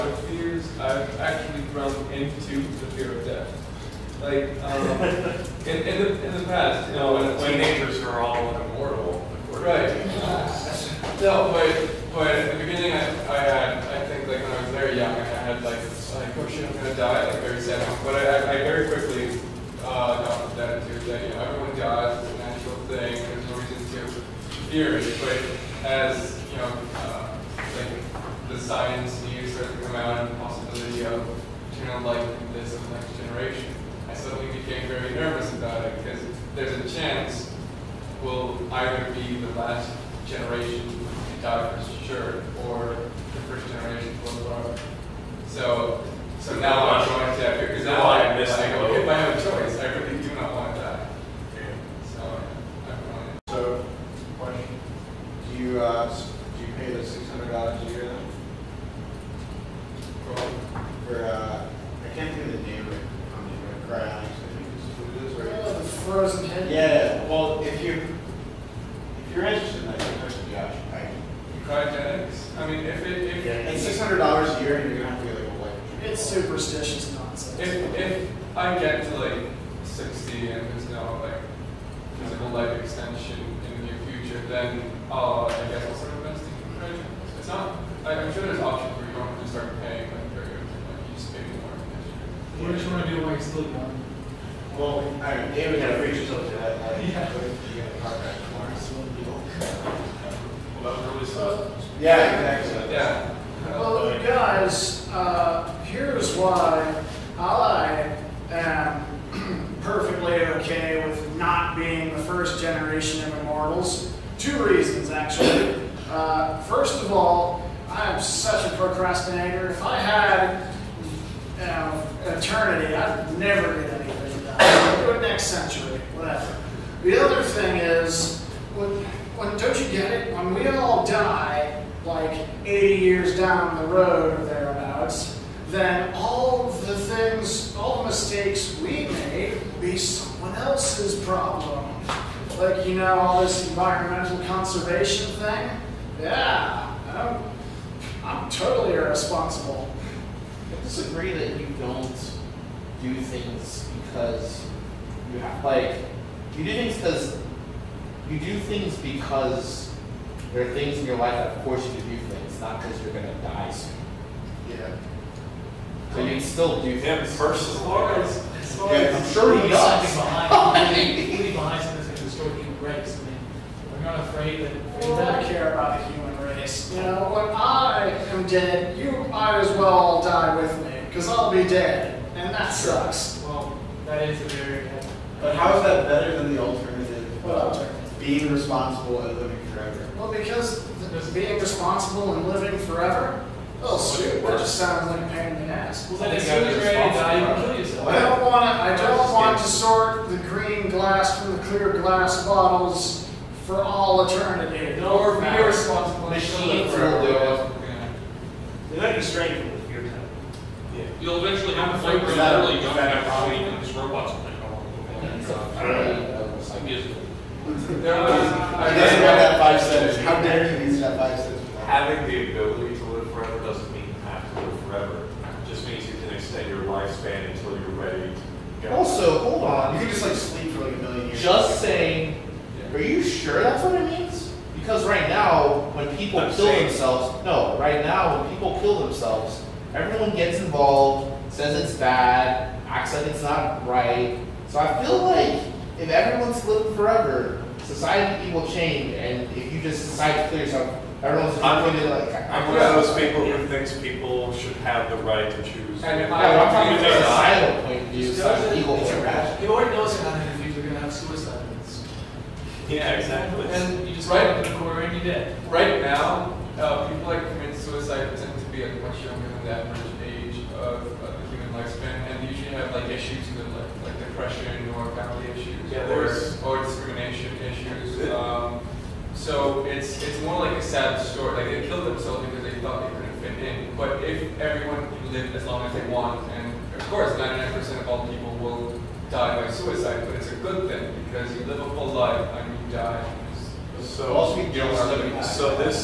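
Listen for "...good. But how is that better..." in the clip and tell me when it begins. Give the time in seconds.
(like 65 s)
184 s.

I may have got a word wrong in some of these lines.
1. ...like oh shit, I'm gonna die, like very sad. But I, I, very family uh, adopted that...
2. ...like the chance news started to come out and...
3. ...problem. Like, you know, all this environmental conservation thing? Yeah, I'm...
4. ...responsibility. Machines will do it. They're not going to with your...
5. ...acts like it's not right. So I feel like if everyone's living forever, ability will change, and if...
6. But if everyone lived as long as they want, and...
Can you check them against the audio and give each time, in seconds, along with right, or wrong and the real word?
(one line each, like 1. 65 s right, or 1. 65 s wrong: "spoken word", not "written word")
1. 16 s wrong: "quickly", not "family"
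2. 27 s wrong: "science", not "chance"
3. 141 s right
4. 205 s right
5. 242 s wrong: "society", not "ability"
6. 283 s right.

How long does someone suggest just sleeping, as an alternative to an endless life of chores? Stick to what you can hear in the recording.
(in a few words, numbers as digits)
A million years.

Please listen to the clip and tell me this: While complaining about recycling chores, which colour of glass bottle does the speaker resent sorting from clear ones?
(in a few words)
Green glass.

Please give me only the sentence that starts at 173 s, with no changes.
I mean, we're not afraid that we don't care about the human place.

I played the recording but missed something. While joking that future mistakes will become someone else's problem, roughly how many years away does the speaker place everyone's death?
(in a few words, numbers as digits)
80 years.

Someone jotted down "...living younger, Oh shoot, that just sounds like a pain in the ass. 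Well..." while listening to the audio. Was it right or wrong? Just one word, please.
wrong.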